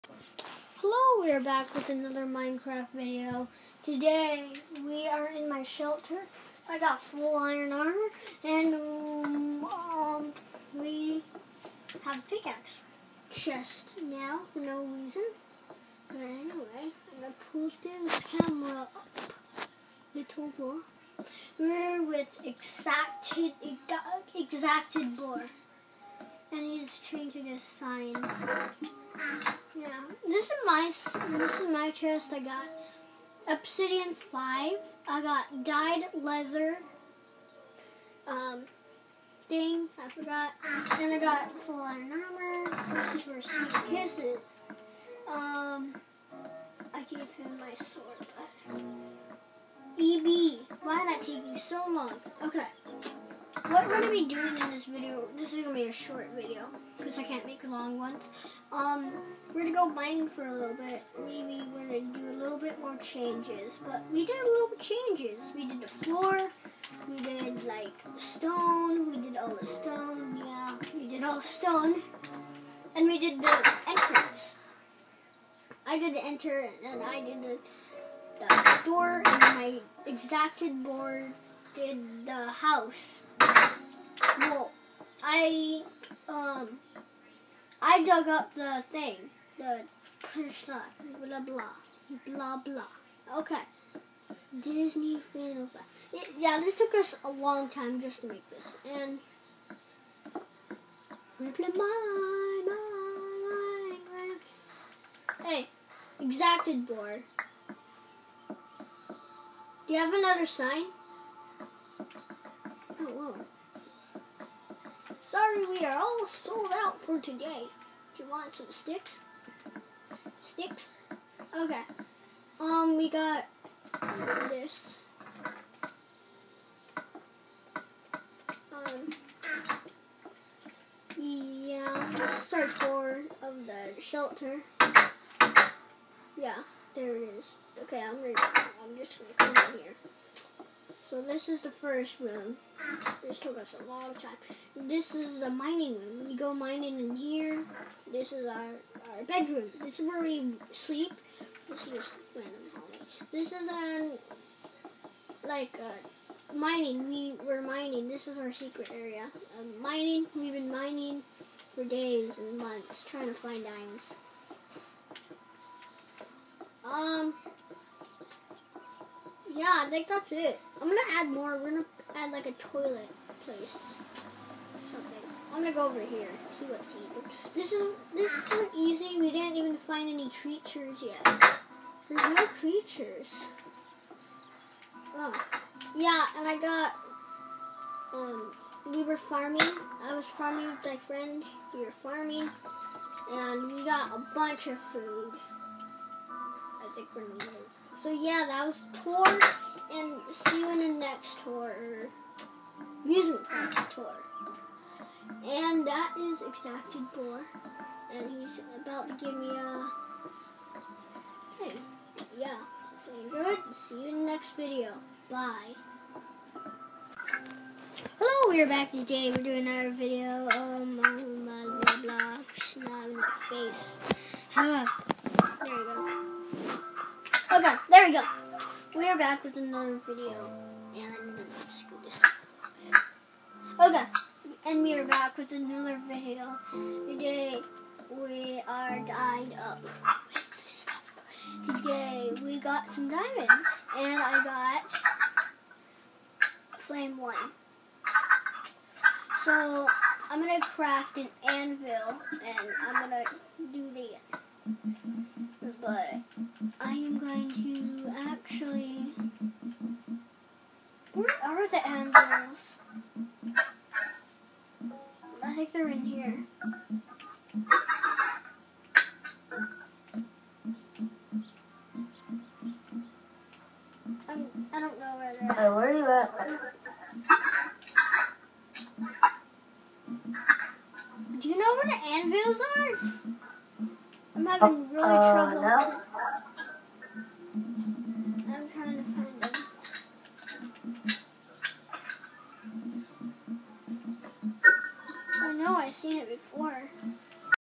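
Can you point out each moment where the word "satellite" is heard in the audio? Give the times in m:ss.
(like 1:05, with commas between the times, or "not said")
not said.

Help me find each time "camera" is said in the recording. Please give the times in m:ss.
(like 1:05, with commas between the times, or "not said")
0:18.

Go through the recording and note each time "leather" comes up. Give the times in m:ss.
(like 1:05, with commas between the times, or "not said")
0:36.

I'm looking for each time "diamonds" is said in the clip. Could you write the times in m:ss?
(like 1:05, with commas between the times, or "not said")
2:43, 4:03.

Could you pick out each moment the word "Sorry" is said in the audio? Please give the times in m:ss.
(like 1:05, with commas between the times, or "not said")
1:55.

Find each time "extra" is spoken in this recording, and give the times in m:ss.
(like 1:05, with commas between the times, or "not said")
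not said.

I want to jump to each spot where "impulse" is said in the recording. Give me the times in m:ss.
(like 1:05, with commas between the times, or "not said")
not said.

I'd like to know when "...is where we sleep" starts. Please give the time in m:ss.
2:29.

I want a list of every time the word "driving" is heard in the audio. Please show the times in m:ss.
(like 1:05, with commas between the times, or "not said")
not said.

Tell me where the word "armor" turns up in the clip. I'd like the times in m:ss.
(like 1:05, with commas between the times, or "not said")
0:07, 0:42.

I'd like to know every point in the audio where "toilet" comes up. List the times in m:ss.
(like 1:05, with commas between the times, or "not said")
2:52.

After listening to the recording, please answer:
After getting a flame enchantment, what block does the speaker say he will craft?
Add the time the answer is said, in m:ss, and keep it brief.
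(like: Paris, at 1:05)
an anvil, at 4:11.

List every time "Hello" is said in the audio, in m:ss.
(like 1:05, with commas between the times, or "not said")
0:00, 3:38.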